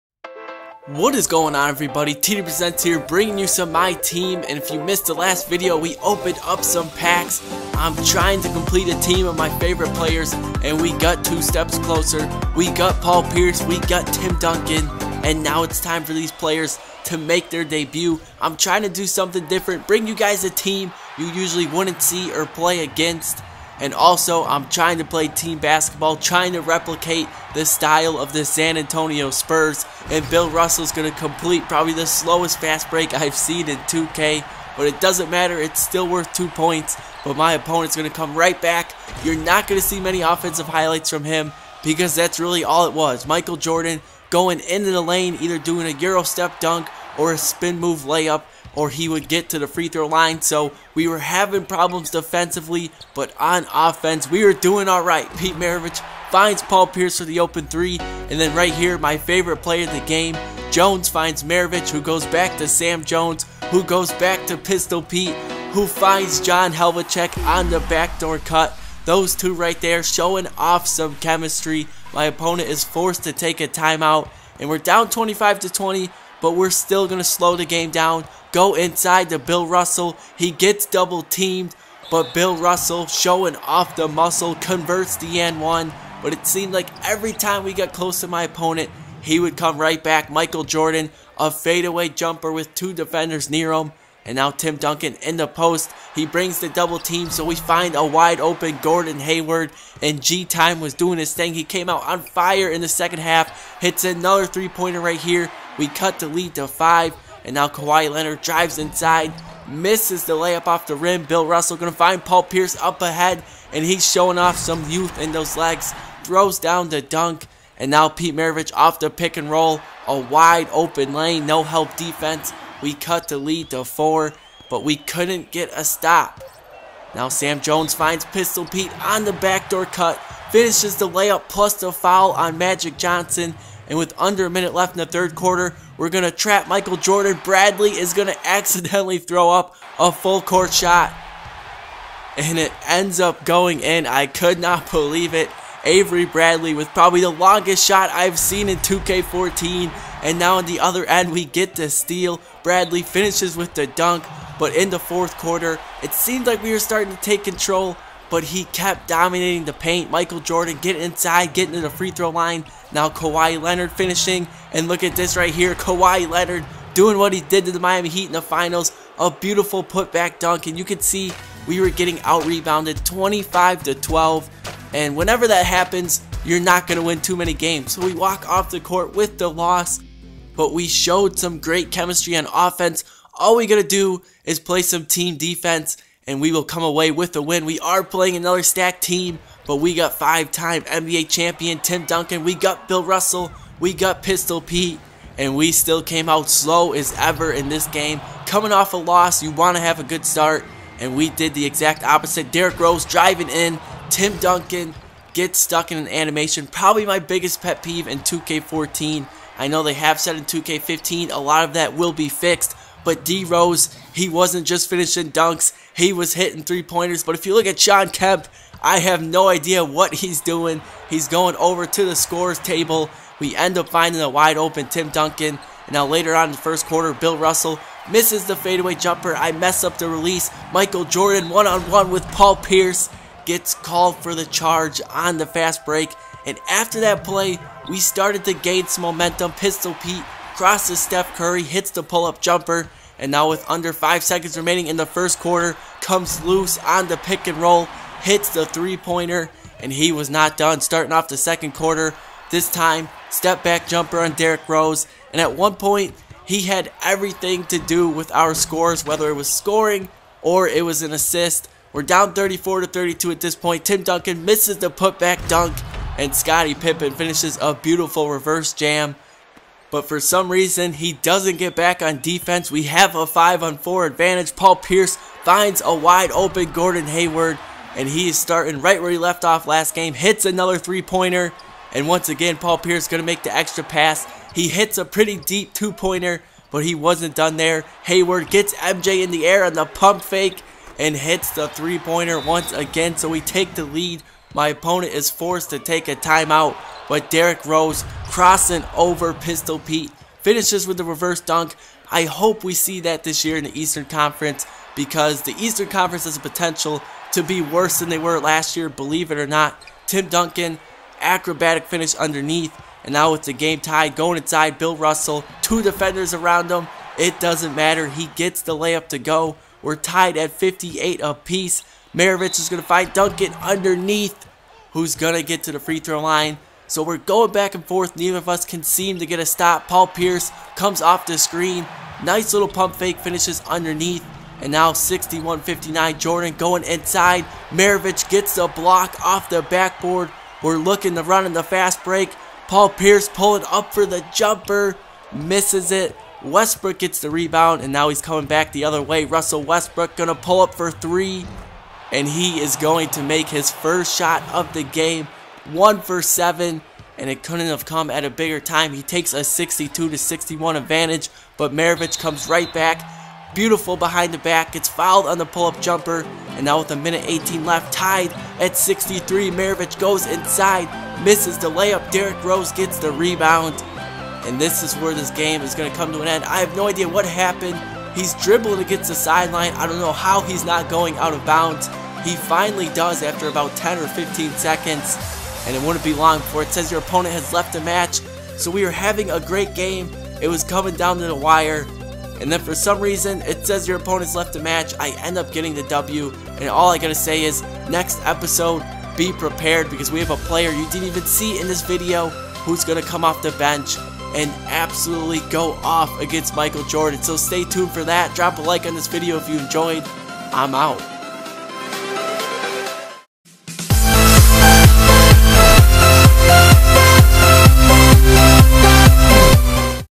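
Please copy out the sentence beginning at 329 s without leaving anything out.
Paul Pierce comes off the screen.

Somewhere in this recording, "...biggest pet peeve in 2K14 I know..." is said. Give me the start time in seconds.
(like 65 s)
207 s.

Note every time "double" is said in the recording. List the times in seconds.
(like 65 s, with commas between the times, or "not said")
80 s, 96 s.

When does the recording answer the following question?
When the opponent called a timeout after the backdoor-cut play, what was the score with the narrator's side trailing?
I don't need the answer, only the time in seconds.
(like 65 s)
75 s.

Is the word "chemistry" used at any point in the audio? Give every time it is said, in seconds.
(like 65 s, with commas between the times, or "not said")
71 s, 181 s.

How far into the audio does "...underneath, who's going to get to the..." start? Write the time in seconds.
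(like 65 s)
323 s.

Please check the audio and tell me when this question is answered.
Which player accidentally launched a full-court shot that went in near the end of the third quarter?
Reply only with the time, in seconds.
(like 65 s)
145 s.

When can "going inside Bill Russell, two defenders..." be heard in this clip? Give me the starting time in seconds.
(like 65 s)
314 s.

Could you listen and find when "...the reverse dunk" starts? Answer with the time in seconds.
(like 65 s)
300 s.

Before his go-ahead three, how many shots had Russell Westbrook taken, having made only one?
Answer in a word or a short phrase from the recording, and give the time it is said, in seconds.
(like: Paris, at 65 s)
7, at 355 s.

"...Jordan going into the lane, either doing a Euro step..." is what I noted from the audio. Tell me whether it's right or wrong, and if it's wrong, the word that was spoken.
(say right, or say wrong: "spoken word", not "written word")
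right.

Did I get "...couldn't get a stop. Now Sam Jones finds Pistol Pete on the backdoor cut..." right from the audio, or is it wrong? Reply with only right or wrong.
right.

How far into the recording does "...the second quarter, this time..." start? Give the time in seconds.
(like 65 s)
251 s.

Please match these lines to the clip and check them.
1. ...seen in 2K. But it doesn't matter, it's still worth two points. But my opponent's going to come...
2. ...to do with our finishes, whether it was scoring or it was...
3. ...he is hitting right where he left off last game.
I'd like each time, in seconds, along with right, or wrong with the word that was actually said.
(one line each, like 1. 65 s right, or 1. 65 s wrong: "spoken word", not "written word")
1. 33 s right
2. 257 s wrong: "scores", not "finishes"
3. 278 s wrong: "starting", not "hitting".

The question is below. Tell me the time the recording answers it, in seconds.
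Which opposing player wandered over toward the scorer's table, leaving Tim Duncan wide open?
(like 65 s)
217 s.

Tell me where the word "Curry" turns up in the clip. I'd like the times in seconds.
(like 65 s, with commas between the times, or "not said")
241 s.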